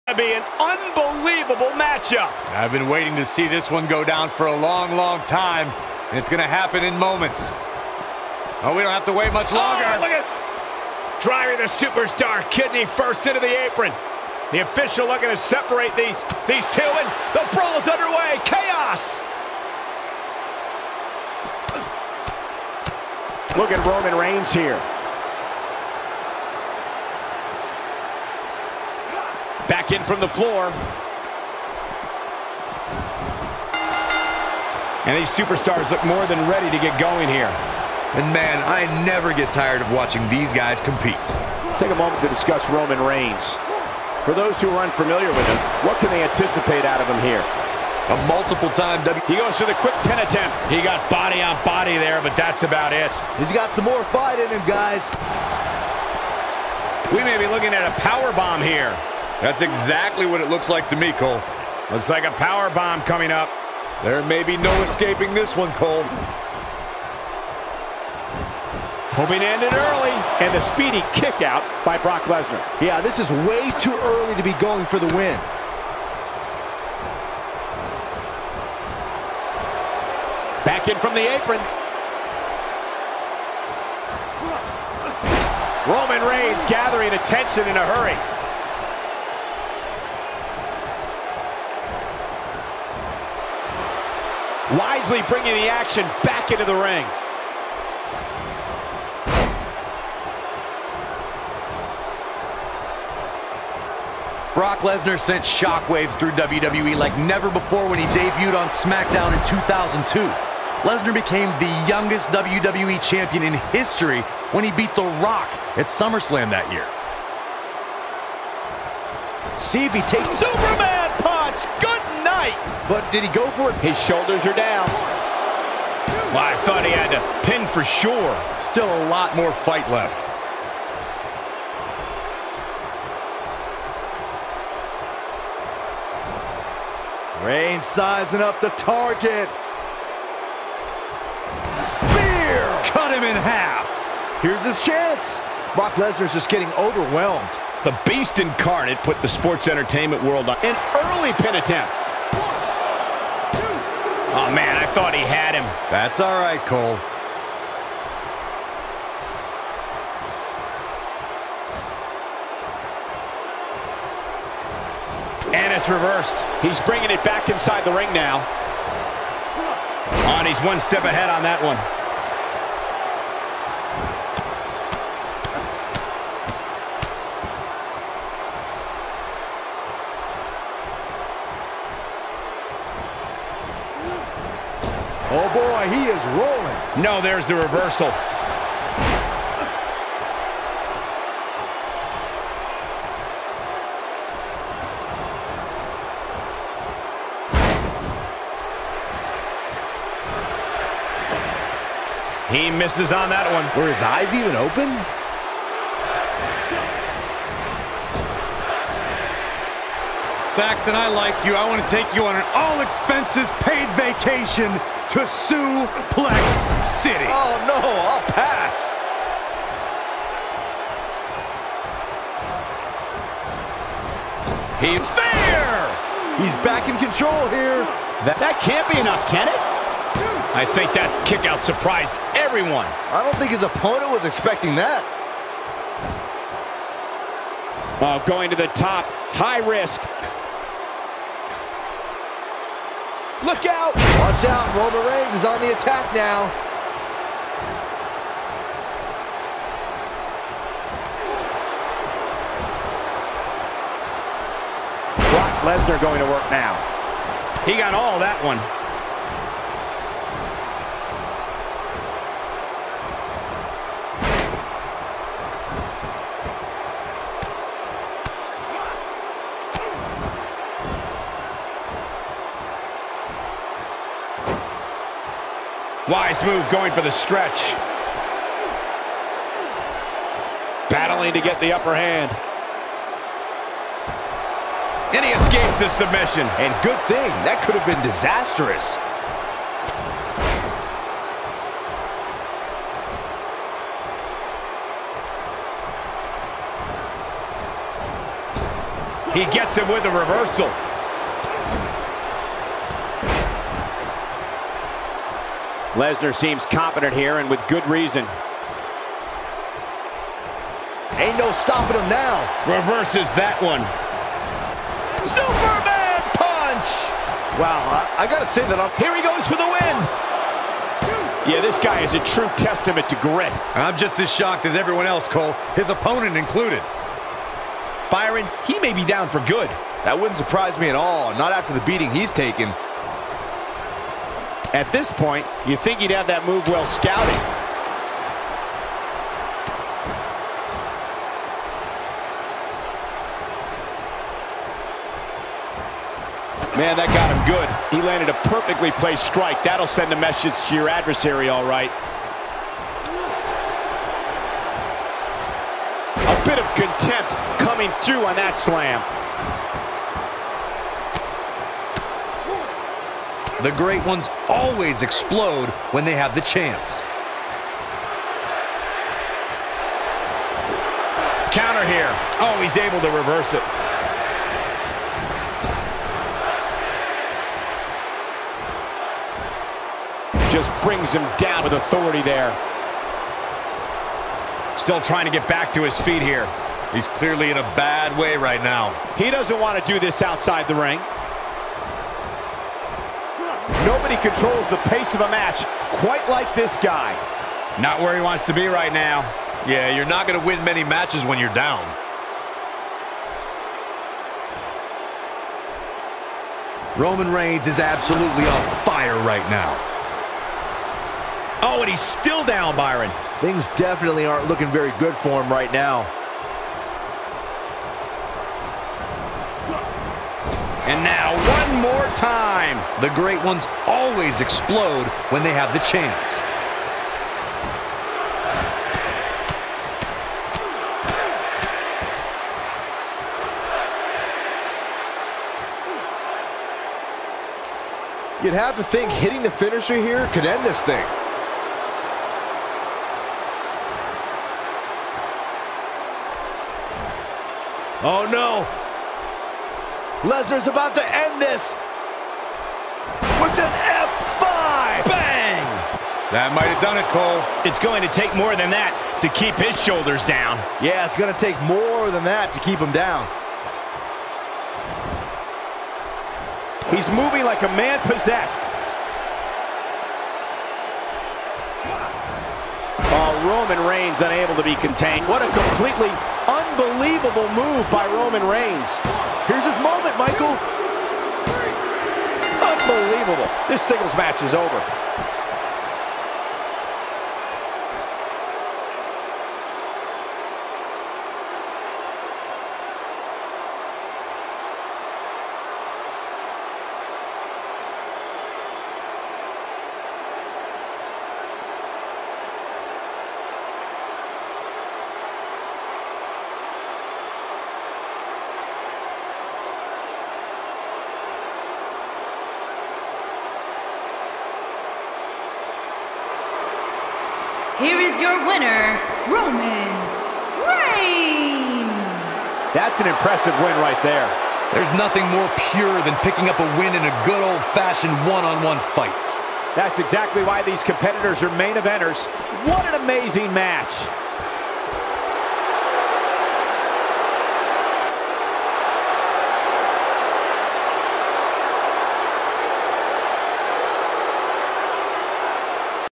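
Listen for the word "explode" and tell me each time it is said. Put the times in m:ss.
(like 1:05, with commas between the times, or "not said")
6:05, 7:04.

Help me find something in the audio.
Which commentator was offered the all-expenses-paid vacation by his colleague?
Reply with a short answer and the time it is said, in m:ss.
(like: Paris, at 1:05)
Saxton, at 3:30.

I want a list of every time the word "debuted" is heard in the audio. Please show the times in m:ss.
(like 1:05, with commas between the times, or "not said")
1:48.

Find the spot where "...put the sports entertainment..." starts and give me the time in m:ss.
2:28.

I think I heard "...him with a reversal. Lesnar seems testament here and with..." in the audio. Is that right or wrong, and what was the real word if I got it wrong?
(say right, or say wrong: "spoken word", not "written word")
wrong: "competent", not "testament".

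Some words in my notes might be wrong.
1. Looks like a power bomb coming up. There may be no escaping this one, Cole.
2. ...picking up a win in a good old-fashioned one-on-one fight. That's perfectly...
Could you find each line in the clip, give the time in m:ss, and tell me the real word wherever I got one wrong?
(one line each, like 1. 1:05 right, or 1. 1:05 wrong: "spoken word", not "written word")
1. 1:01 right
2. 8:46 wrong: "exactly", not "perfectly".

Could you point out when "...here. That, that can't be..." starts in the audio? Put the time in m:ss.
3:47.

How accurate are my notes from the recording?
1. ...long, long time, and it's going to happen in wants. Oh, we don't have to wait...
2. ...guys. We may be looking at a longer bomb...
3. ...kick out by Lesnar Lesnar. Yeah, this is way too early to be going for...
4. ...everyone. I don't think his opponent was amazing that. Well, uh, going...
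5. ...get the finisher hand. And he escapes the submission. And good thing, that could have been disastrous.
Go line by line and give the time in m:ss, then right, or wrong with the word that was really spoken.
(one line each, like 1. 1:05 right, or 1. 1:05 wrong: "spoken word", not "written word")
1. 0:04 wrong: "moments", not "wants"
2. 0:54 wrong: "power", not "longer"
3. 1:11 wrong: "Brock", not "Lesnar"
4. 3:52 wrong: "expecting", not "amazing"
5. 4:41 wrong: "upper", not "finisher".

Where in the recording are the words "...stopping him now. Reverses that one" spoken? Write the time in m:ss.
5:11.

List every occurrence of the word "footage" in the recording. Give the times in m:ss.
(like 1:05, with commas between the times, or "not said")
not said.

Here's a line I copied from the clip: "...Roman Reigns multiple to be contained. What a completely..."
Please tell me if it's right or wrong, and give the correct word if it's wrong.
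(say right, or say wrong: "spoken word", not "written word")
wrong: "unable", not "multiple".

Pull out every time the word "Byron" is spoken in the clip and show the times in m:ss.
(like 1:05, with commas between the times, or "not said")
5:28, 6:52.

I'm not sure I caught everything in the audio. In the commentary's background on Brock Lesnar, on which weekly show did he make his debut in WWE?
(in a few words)
SmackDown.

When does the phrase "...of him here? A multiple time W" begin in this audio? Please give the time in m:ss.
0:46.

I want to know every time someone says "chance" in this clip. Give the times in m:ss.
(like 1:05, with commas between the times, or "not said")
2:24, 6:06, 7:05.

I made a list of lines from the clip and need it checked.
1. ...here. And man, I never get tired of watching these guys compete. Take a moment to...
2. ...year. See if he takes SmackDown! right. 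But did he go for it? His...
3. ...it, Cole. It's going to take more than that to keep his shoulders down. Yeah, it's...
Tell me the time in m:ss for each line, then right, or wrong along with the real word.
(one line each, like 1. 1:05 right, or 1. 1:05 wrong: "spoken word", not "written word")
1. 0:37 right
2. 1:56 wrong: "Superman", not "SmackDown"
3. 7:36 right.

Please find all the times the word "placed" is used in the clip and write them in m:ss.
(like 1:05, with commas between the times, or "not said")
5:48.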